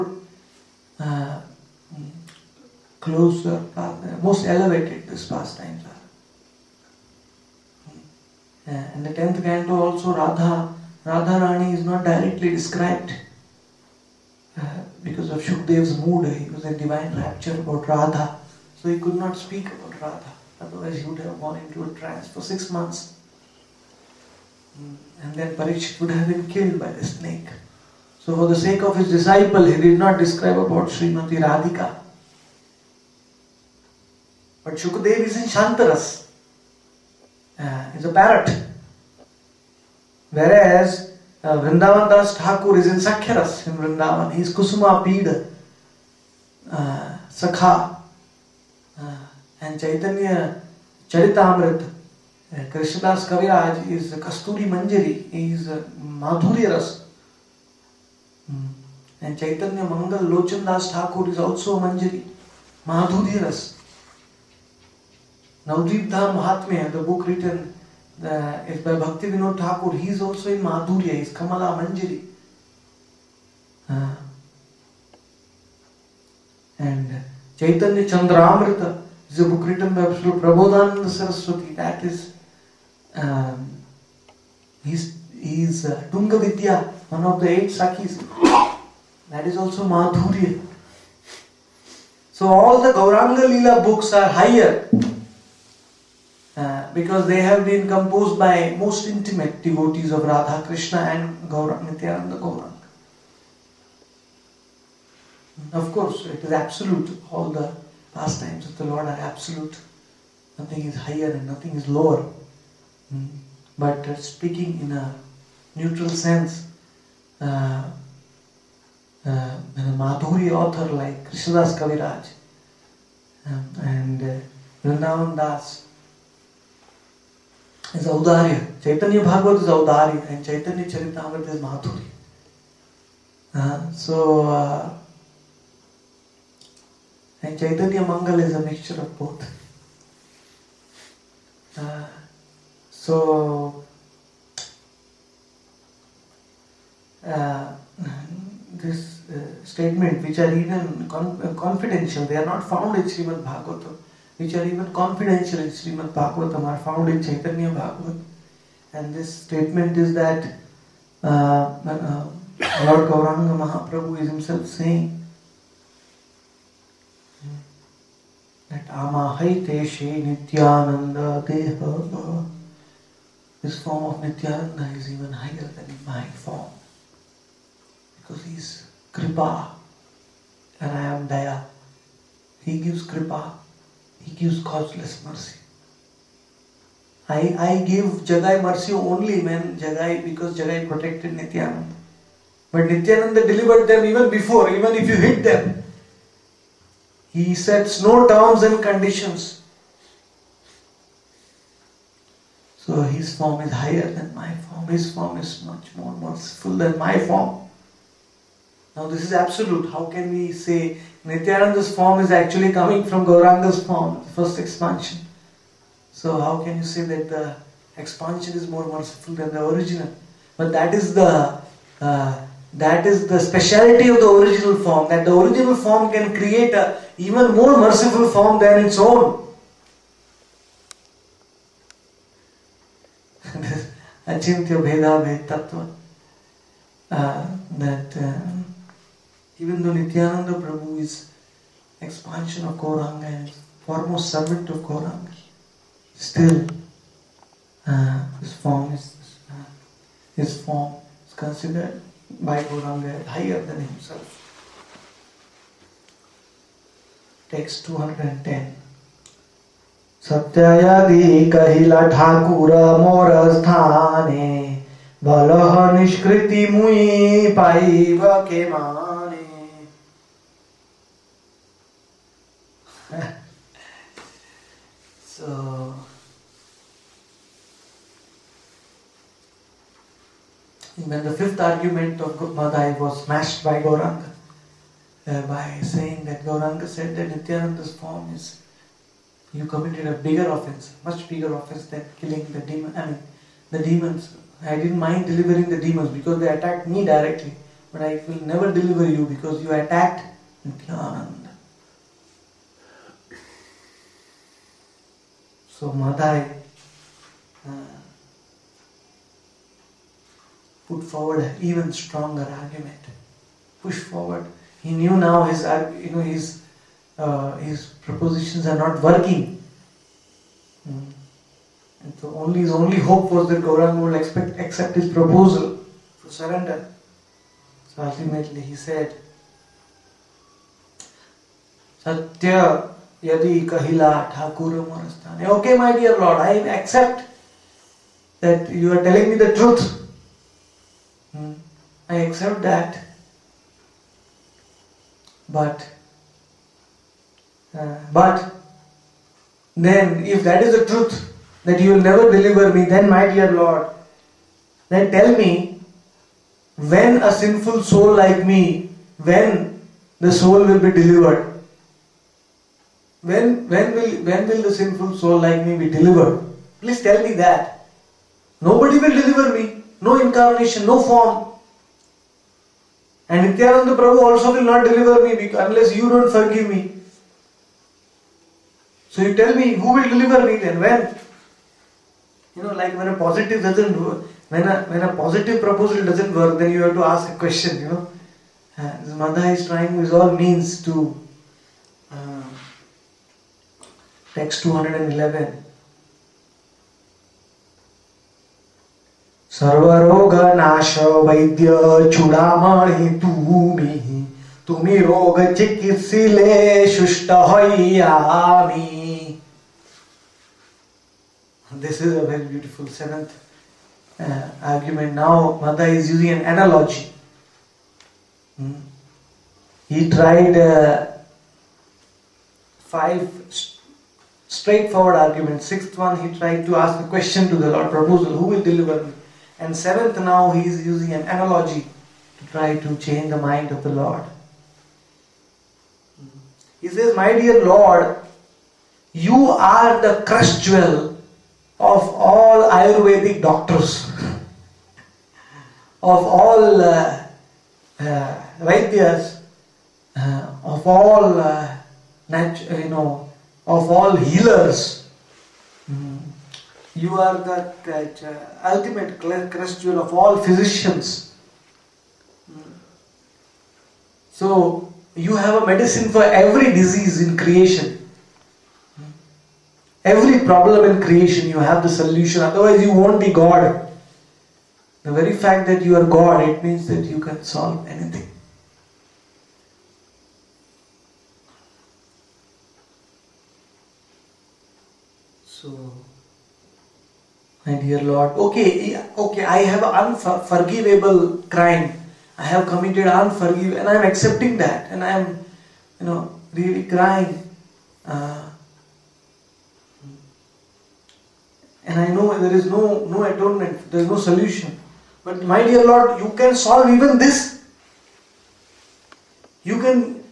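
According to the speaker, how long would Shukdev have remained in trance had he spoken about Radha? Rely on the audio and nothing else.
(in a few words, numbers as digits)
6 months.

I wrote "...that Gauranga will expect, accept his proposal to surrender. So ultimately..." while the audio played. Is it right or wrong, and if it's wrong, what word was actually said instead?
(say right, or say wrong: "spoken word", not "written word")
right.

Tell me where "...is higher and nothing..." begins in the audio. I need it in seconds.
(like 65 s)
110 s.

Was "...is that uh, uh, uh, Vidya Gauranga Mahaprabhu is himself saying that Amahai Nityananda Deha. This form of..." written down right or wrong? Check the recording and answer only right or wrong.
wrong.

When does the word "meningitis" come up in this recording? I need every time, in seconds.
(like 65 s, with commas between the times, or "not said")
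not said.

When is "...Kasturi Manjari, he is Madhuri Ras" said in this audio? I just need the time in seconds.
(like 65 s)
54 s.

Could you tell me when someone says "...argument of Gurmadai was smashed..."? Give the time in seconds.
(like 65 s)
281 s.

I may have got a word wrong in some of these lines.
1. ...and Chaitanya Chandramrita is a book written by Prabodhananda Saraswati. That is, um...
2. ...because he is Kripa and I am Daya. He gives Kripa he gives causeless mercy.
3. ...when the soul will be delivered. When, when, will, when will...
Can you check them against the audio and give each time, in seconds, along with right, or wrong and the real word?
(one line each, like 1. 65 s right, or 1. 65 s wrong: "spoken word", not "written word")
1. 76 s right
2. 178 s right
3. 359 s right.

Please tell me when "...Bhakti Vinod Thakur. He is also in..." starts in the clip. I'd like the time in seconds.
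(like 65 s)
68 s.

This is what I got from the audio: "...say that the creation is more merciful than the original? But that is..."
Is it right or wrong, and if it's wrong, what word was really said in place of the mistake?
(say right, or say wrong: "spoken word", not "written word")
wrong: "expansion", not "creation".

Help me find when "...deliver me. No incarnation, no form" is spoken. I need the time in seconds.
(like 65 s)
369 s.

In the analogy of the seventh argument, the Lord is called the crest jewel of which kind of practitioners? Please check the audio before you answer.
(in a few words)
Ayurvedic doctors.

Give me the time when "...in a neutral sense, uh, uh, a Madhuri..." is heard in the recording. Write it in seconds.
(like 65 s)
114 s.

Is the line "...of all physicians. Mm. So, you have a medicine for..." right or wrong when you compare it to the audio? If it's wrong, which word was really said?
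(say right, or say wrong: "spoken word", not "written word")
right.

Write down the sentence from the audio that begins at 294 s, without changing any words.
I didn't mind delivering the demons because they attacked me directly, but I will never deliver you because you attacked Nityananda.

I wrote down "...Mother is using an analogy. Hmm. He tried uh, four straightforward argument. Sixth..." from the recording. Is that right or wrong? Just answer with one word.
wrong.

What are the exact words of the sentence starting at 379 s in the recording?
So you tell me who will deliver me then?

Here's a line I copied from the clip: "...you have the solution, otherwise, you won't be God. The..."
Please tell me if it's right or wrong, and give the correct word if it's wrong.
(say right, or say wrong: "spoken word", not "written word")
right.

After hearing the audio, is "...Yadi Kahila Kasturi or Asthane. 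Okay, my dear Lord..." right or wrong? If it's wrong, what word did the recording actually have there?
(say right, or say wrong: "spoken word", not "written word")
wrong: "Thakuram", not "Kasturi".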